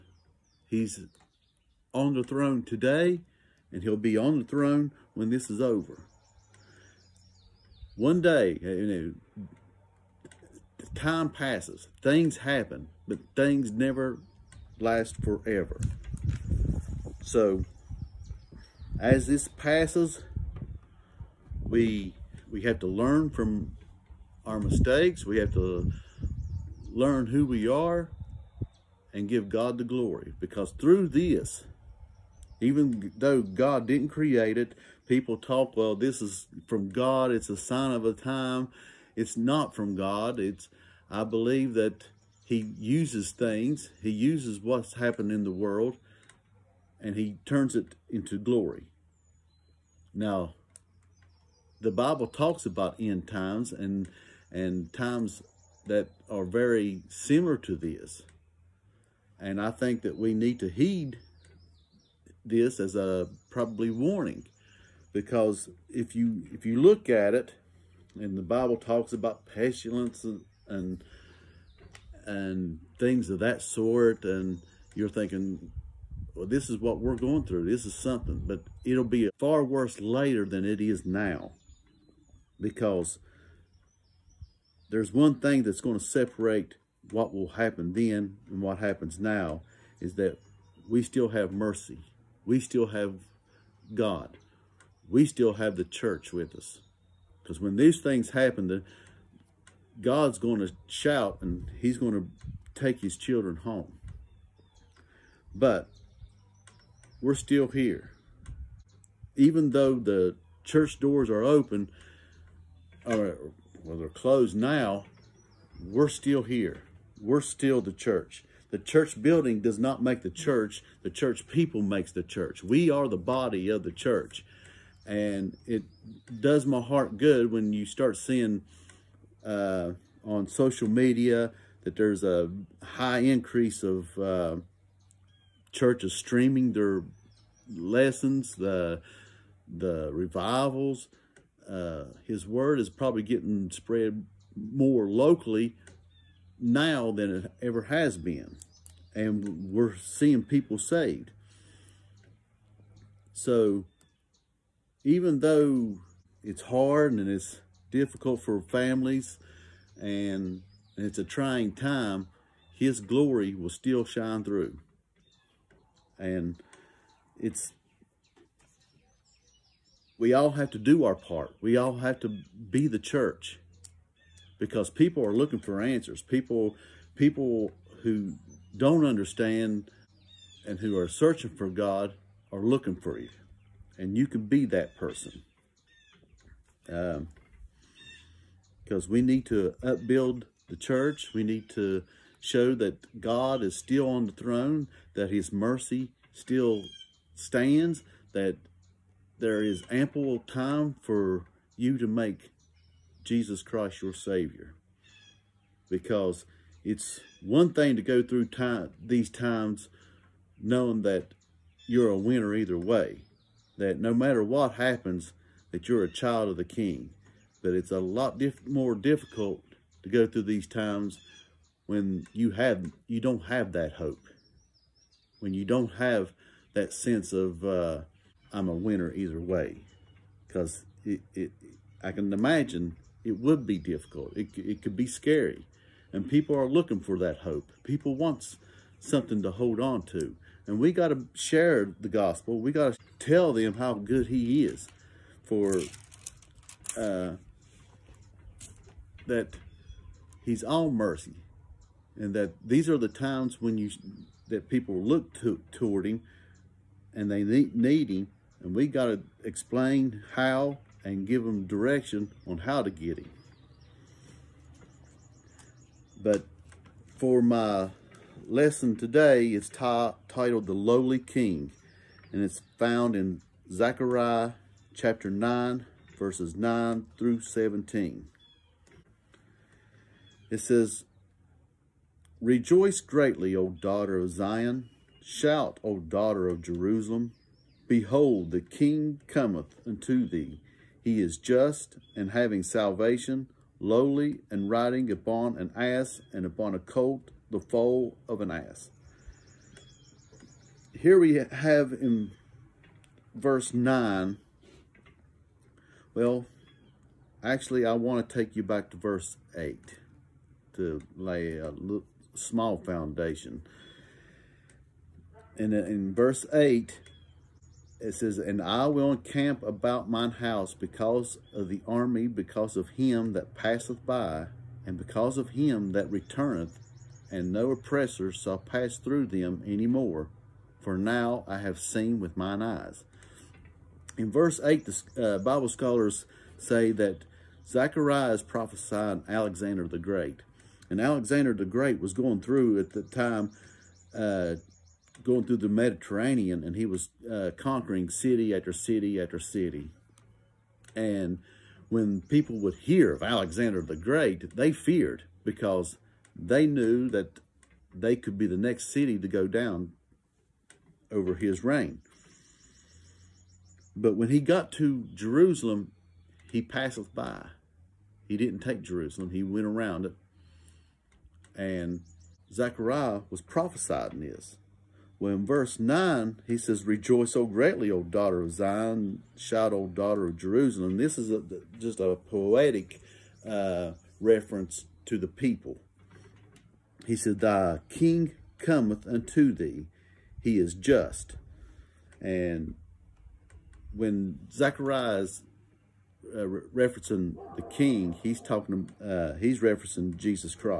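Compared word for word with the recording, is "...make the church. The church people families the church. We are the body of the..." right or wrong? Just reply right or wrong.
wrong.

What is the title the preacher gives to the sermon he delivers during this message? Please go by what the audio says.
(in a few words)
The Lowly King.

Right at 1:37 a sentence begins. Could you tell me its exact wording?
Because when these things happen, the, God's going to shout and he's going to take his children home.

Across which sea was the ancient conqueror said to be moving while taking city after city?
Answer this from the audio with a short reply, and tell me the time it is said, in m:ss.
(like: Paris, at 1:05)
Mediterranean, at 5:45.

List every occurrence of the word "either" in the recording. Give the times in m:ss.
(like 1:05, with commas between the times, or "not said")
3:32, 3:49.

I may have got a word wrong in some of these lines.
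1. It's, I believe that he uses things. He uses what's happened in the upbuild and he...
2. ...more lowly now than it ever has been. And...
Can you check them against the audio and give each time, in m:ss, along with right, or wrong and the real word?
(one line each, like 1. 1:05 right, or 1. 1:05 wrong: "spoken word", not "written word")
1. 0:40 wrong: "world", not "upbuild"
2. 2:24 wrong: "locally", not "lowly".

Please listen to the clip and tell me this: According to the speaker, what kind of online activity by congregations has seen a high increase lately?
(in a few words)
Streaming their lessons.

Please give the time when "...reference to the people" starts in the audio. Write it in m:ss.
6:24.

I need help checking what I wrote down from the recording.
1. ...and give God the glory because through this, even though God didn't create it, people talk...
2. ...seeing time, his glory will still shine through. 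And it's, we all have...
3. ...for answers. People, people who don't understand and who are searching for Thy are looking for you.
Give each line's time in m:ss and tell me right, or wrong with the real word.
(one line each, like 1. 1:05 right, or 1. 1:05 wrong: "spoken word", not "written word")
1. 0:29 right
2. 2:41 wrong: "trying", not "seeing"
3. 2:55 wrong: "God", not "Thy".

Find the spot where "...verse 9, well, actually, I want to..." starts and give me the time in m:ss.
5:03.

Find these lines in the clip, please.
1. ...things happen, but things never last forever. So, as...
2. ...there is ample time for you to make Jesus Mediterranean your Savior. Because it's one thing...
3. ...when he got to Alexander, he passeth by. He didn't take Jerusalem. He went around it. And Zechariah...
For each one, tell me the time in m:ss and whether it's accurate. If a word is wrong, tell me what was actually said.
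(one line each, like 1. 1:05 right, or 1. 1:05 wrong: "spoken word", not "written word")
1. 0:12 right
2. 3:19 wrong: "Christ", not "Mediterranean"
3. 6:04 wrong: "Jerusalem", not "Alexander".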